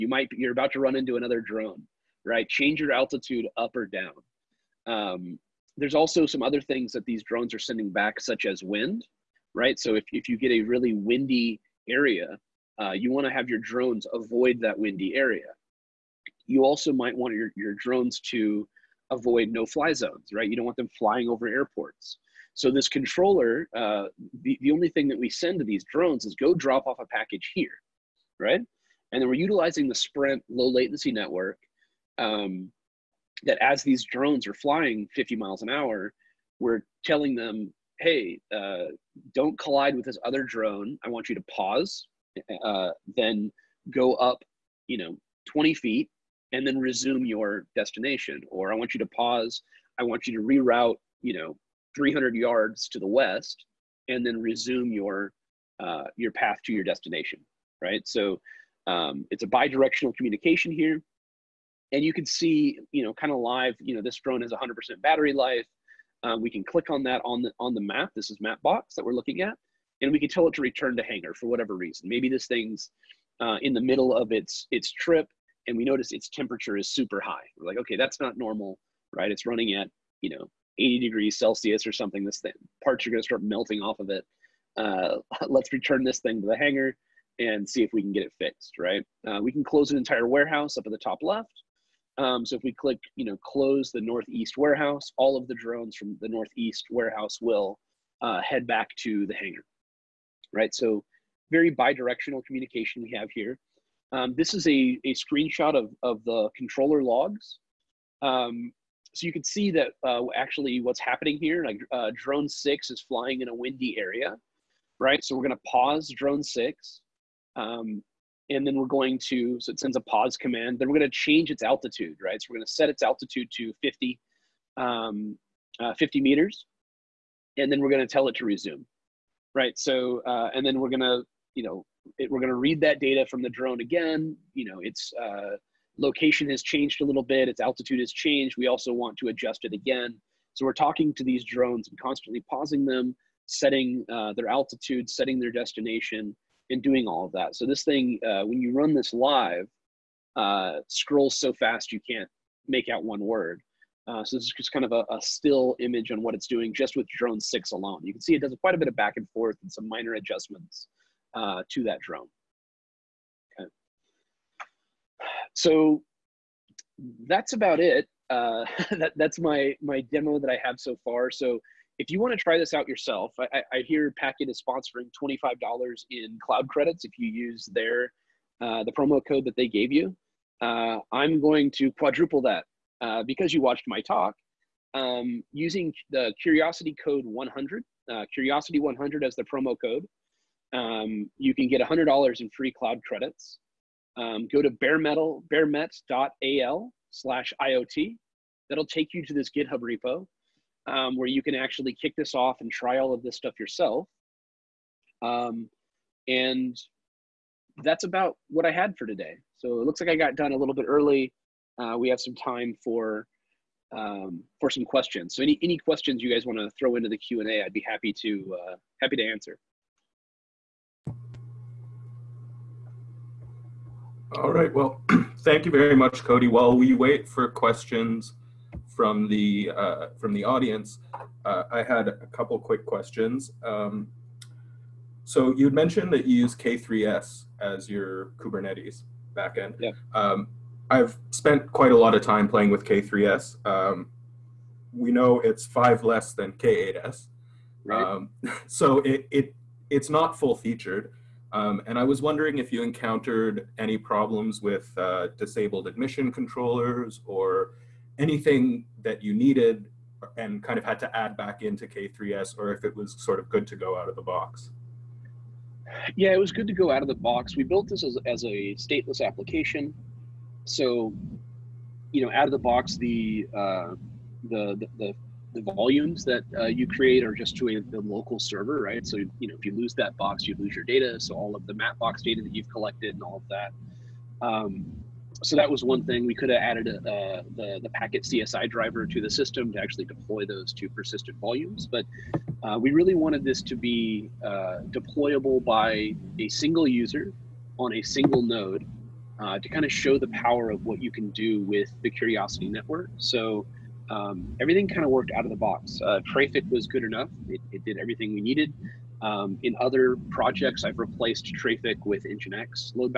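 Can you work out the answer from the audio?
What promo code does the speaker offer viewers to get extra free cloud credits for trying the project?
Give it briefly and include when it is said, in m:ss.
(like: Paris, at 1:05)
Curiosity 100, at 3:08.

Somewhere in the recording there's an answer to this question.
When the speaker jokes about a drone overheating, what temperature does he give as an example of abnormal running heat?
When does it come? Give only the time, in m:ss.
1:20.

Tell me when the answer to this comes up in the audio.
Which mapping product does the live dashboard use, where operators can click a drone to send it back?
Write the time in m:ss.
1:08.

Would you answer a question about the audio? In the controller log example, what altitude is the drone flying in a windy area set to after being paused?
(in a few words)
50 meters.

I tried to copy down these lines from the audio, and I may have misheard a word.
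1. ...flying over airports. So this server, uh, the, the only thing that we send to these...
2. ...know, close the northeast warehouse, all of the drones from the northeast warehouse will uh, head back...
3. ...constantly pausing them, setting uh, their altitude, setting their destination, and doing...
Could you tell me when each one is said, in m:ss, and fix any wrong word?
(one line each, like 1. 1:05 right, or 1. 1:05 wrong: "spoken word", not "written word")
1. 0:20 wrong: "controller", not "server"
2. 1:33 right
3. 2:21 right.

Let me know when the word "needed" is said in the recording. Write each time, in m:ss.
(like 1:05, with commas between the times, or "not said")
4:19, 5:08.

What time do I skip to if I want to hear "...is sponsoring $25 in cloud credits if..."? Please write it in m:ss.
2:54.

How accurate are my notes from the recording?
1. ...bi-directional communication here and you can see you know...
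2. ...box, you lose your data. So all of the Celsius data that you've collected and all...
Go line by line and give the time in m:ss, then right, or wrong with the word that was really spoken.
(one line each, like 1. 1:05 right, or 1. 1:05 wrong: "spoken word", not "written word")
1. 0:59 right
2. 4:40 wrong: "Mapbox", not "Celsius".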